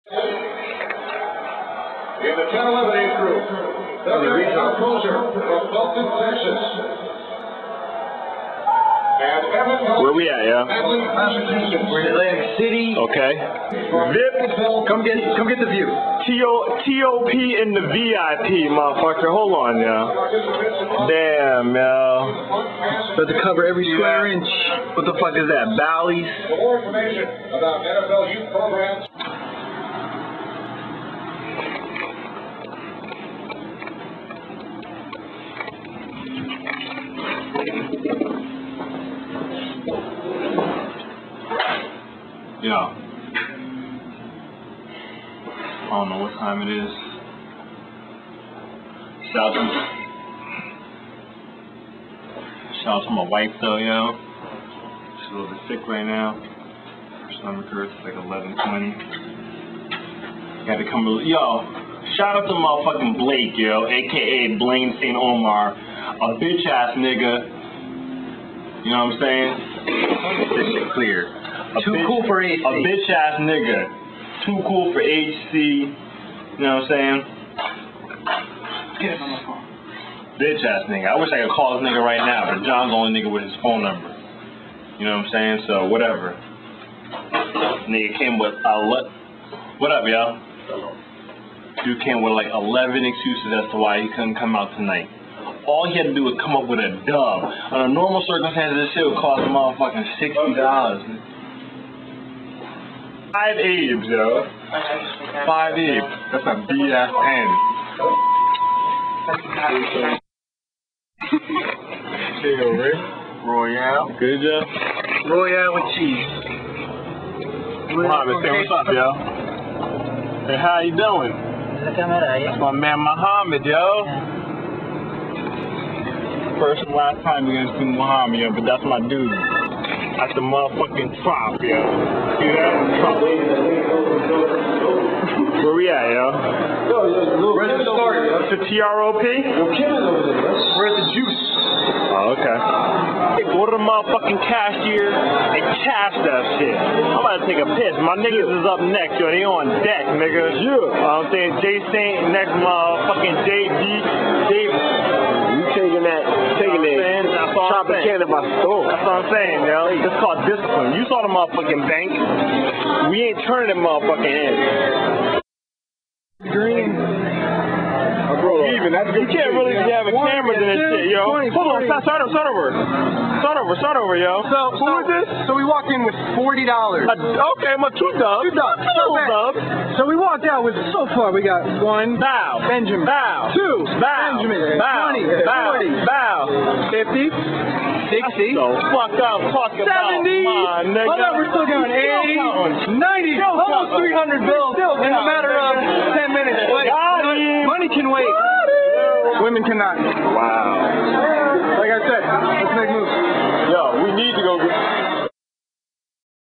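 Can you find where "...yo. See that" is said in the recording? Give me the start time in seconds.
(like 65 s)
131 s.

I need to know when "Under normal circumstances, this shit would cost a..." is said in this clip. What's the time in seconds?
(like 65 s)
97 s.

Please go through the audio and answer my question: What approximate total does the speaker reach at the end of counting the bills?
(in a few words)
almost 300.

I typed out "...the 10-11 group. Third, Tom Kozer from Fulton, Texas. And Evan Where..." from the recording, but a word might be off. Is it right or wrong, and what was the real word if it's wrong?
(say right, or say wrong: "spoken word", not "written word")
right.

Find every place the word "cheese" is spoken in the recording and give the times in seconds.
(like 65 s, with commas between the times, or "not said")
115 s.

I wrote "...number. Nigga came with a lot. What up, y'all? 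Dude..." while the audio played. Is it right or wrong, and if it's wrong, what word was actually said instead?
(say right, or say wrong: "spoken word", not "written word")
wrong: "whatever", not "number".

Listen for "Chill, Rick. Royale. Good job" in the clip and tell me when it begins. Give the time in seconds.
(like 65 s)
112 s.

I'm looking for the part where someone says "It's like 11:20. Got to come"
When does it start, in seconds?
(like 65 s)
57 s.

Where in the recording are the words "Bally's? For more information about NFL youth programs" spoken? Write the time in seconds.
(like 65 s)
25 s.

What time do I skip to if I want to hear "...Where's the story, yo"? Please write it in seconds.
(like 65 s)
137 s.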